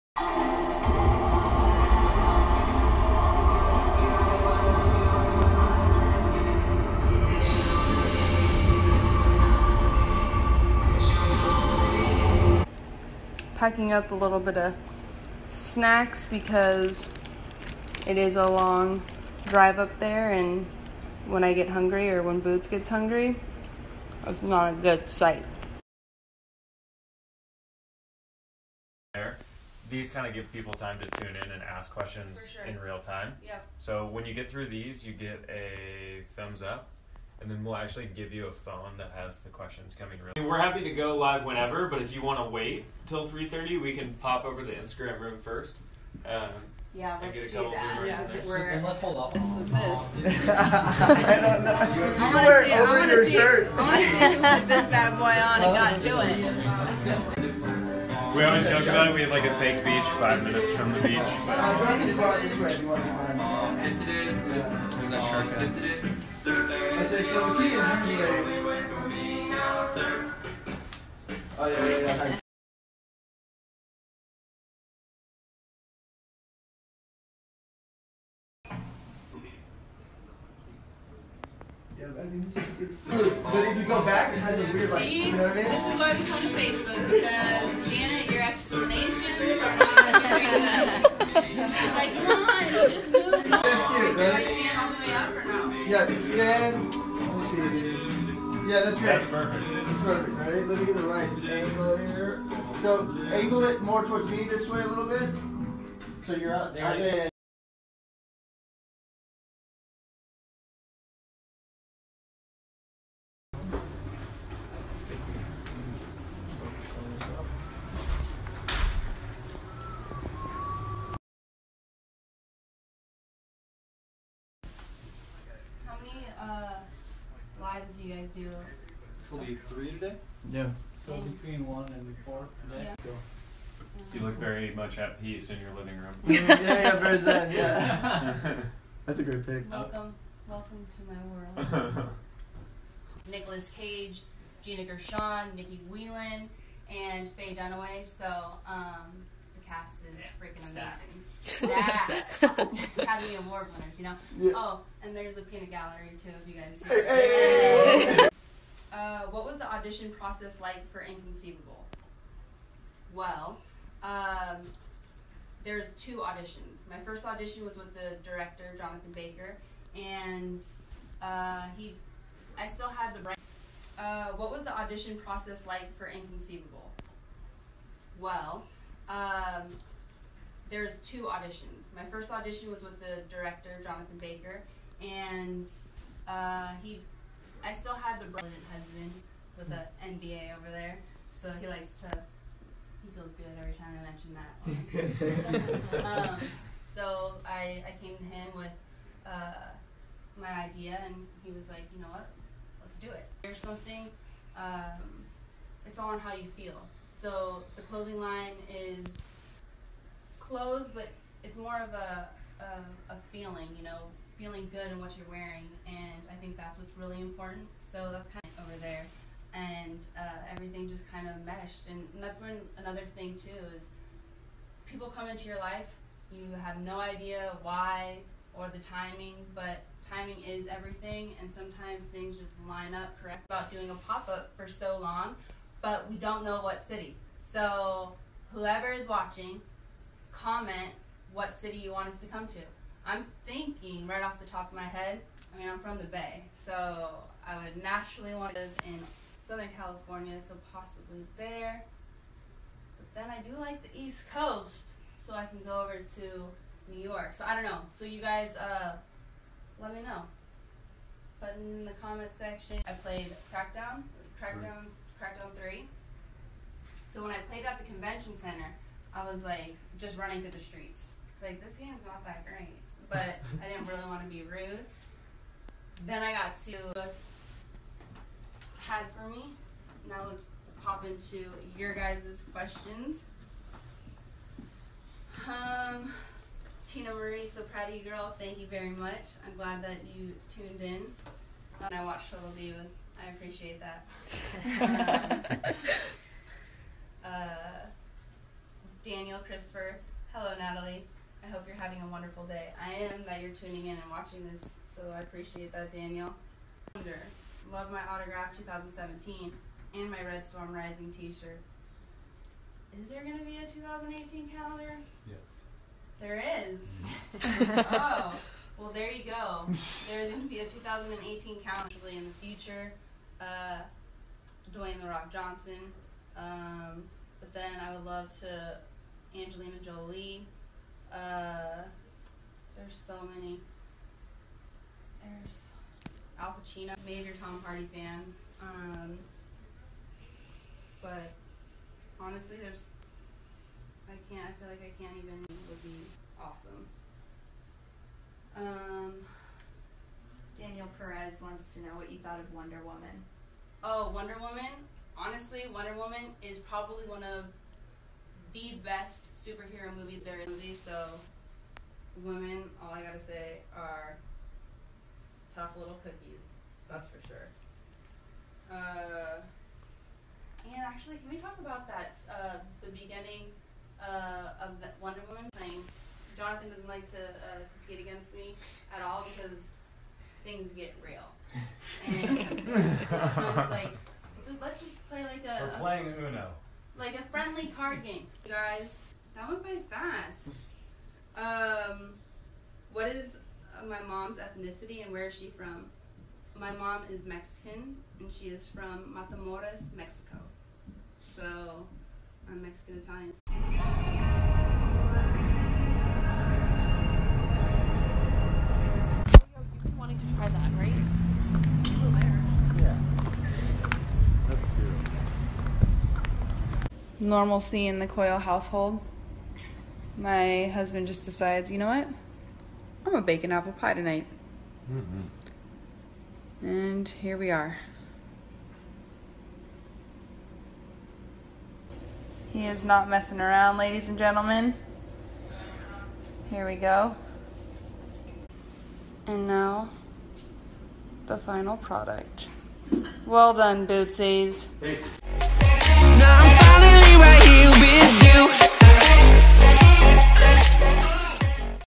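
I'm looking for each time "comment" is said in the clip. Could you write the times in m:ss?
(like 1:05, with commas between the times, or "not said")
4:00, 4:22.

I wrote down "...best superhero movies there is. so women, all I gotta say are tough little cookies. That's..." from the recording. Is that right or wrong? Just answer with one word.
right.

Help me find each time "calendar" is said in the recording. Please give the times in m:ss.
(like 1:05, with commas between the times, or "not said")
5:14, 5:21.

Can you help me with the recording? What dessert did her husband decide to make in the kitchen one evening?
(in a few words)
bacon apple pie.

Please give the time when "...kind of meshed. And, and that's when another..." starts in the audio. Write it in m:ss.
3:41.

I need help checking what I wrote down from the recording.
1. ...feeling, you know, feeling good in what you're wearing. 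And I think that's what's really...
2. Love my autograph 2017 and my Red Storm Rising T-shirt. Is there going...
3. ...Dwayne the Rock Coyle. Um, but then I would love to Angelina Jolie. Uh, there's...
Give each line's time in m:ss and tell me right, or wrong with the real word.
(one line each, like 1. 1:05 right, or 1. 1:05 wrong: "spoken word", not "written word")
1. 3:33 right
2. 5:07 right
3. 5:24 wrong: "Johnson", not "Coyle".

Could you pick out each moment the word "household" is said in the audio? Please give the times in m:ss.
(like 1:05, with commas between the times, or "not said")
6:58.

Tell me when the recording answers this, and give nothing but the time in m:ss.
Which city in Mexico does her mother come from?
6:39.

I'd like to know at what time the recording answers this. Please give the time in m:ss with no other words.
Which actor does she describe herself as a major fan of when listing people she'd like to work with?
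5:37.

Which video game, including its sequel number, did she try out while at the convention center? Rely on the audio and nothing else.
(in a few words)
Crackdown 3.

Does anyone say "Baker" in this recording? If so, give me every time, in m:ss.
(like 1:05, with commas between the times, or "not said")
2:49, 3:04.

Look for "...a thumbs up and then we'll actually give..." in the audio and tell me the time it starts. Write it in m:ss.
0:35.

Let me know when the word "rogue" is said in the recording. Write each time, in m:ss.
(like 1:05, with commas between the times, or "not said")
not said.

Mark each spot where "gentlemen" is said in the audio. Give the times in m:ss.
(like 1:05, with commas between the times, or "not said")
7:14.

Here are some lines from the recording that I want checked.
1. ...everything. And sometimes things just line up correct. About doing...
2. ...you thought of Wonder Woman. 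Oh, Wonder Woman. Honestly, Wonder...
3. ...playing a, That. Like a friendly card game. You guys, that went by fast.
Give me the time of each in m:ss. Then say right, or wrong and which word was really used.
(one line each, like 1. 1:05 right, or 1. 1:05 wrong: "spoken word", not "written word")
1. 3:50 right
2. 5:52 right
3. 6:25 wrong: "Uno", not "That".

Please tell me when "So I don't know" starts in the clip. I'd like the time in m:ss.
4:17.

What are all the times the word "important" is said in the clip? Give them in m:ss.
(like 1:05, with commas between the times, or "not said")
3:37.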